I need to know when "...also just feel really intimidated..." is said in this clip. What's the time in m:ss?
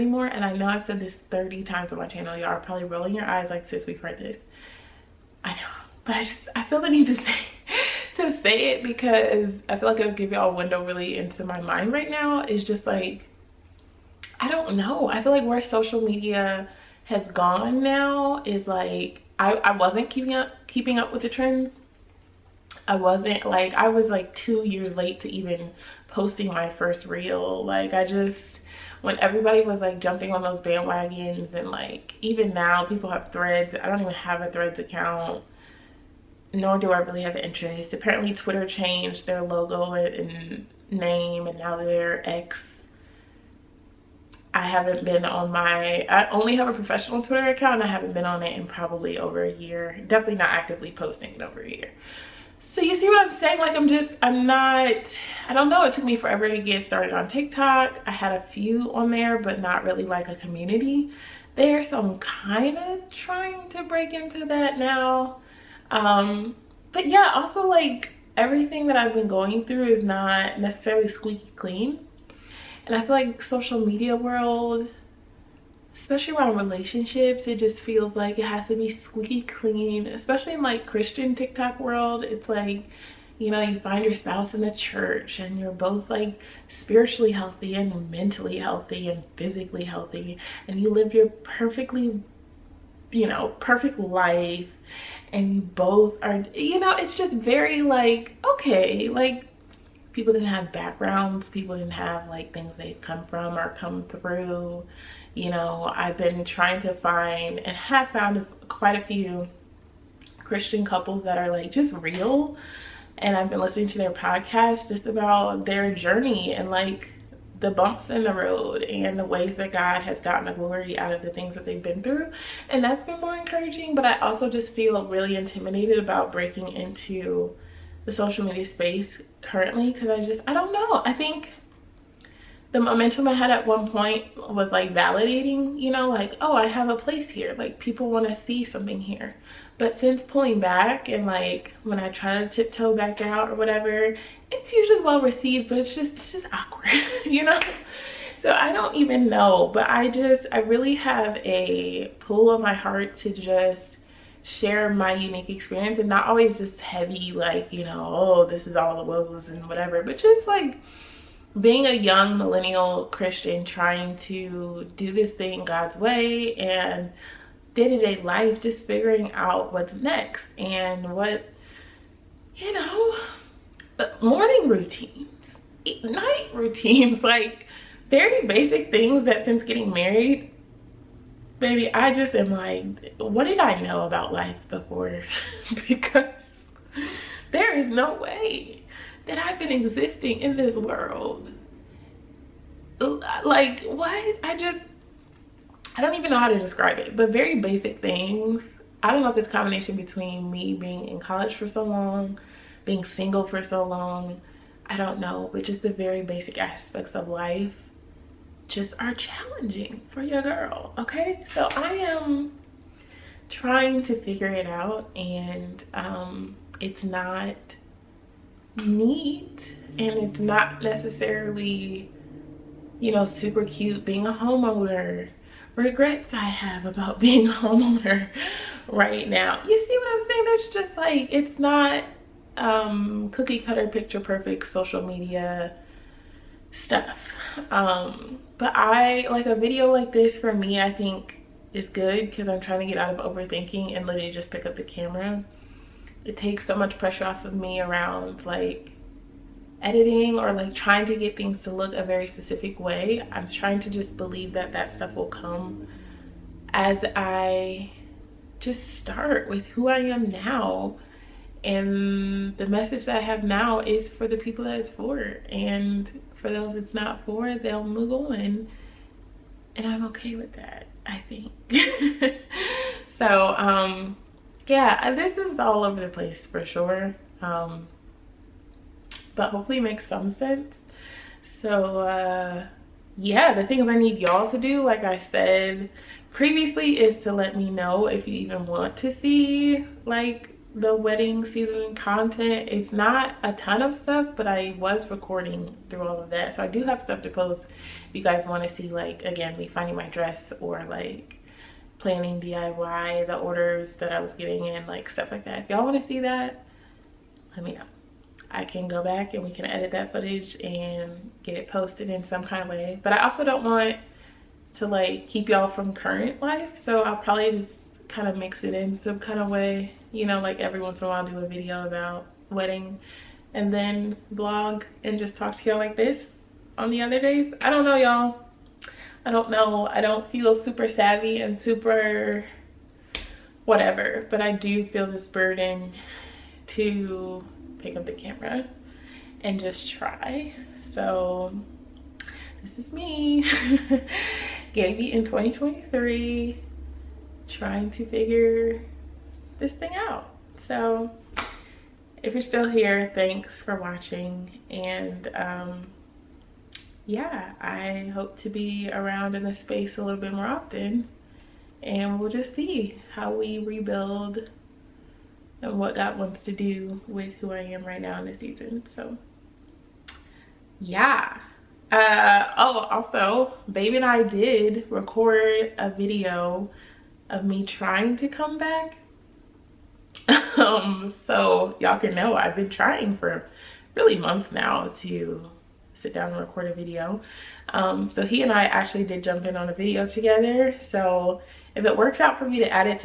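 2:04.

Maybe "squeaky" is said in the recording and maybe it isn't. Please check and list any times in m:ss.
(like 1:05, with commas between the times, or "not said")
1:11, 1:18.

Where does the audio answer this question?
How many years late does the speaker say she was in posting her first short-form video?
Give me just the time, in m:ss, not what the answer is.
0:24.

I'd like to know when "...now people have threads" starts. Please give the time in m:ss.
0:32.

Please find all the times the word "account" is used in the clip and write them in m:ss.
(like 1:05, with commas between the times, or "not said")
0:34, 0:47.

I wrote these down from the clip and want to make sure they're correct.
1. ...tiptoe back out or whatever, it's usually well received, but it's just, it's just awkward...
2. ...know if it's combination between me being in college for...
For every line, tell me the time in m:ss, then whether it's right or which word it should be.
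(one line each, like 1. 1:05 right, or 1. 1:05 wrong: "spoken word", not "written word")
1. 2:22 right
2. 3:19 right.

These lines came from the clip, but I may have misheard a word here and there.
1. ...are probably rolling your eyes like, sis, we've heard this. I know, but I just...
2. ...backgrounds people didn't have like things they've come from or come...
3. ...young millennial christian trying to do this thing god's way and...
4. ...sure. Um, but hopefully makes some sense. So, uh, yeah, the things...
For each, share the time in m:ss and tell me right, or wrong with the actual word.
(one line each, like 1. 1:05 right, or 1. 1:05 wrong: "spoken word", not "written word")
1. 0:02 right
2. 1:40 right
3. 2:41 right
4. 4:36 right.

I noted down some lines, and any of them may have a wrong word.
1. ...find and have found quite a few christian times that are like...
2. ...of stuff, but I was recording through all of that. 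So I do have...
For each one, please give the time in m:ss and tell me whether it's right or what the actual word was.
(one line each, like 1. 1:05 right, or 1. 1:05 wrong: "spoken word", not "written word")
1. 1:46 wrong: "couples", not "times"
2. 4:53 right.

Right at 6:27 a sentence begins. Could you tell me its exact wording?
Um, so he and I actually did jump in on a video together.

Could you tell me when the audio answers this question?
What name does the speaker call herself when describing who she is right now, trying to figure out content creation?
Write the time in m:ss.
5:44.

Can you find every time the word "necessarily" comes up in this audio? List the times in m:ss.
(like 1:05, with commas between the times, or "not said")
1:10, 3:40.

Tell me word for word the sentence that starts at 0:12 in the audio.
It's just like, I don't know.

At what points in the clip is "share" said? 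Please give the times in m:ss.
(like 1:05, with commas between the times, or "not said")
2:34.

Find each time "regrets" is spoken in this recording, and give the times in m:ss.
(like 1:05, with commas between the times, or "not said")
3:45.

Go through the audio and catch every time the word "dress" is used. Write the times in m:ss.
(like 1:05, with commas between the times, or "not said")
5:00.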